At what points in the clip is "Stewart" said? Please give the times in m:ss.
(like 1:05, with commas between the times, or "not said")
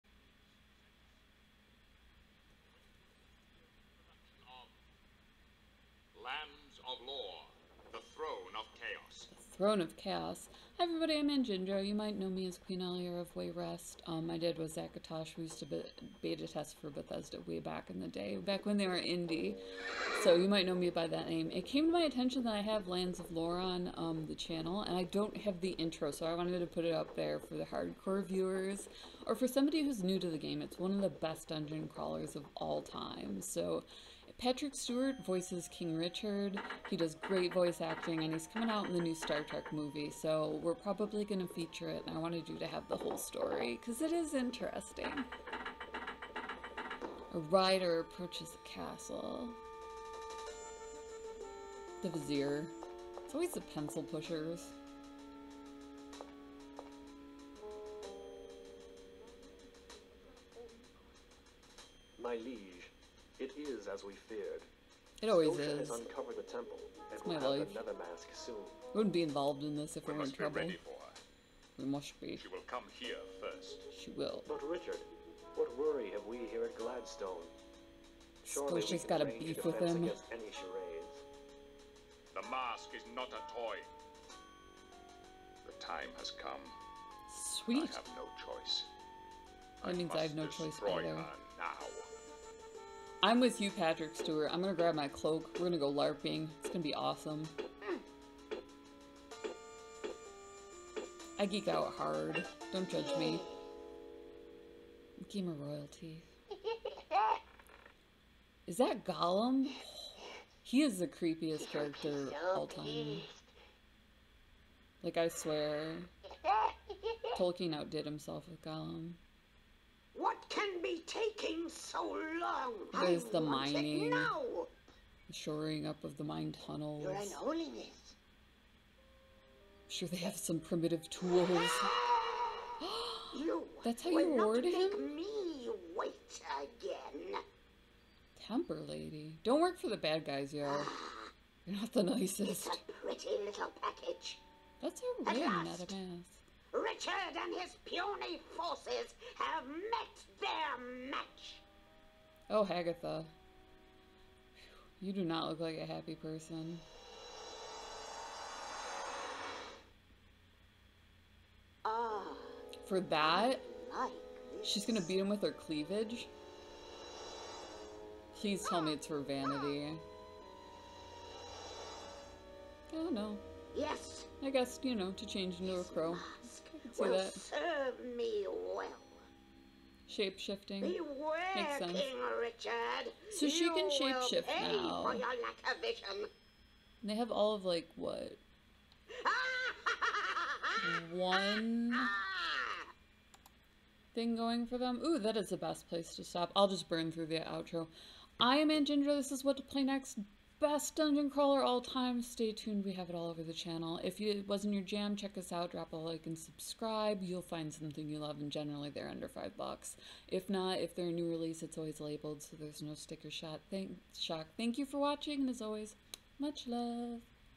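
0:34, 1:34.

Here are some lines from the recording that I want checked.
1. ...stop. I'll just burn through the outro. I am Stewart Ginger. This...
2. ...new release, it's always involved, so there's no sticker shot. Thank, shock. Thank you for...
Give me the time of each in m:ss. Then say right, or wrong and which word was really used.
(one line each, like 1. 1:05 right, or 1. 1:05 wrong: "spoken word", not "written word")
1. 3:16 wrong: "Aunt", not "Stewart"
2. 3:31 wrong: "labeled", not "involved".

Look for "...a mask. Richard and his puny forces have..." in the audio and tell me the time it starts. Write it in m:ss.
2:25.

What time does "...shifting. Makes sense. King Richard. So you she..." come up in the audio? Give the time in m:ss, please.
3:00.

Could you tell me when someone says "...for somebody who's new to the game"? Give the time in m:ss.
0:29.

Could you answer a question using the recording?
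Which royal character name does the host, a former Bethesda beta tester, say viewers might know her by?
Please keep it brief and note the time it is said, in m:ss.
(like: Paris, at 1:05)
Queen Aliera of Wayrest, at 0:12.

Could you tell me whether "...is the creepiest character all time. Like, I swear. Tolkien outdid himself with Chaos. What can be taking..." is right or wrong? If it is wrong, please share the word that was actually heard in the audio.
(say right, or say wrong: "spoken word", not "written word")
wrong: "Gollum", not "Chaos".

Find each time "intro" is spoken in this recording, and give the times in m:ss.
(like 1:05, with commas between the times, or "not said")
0:25.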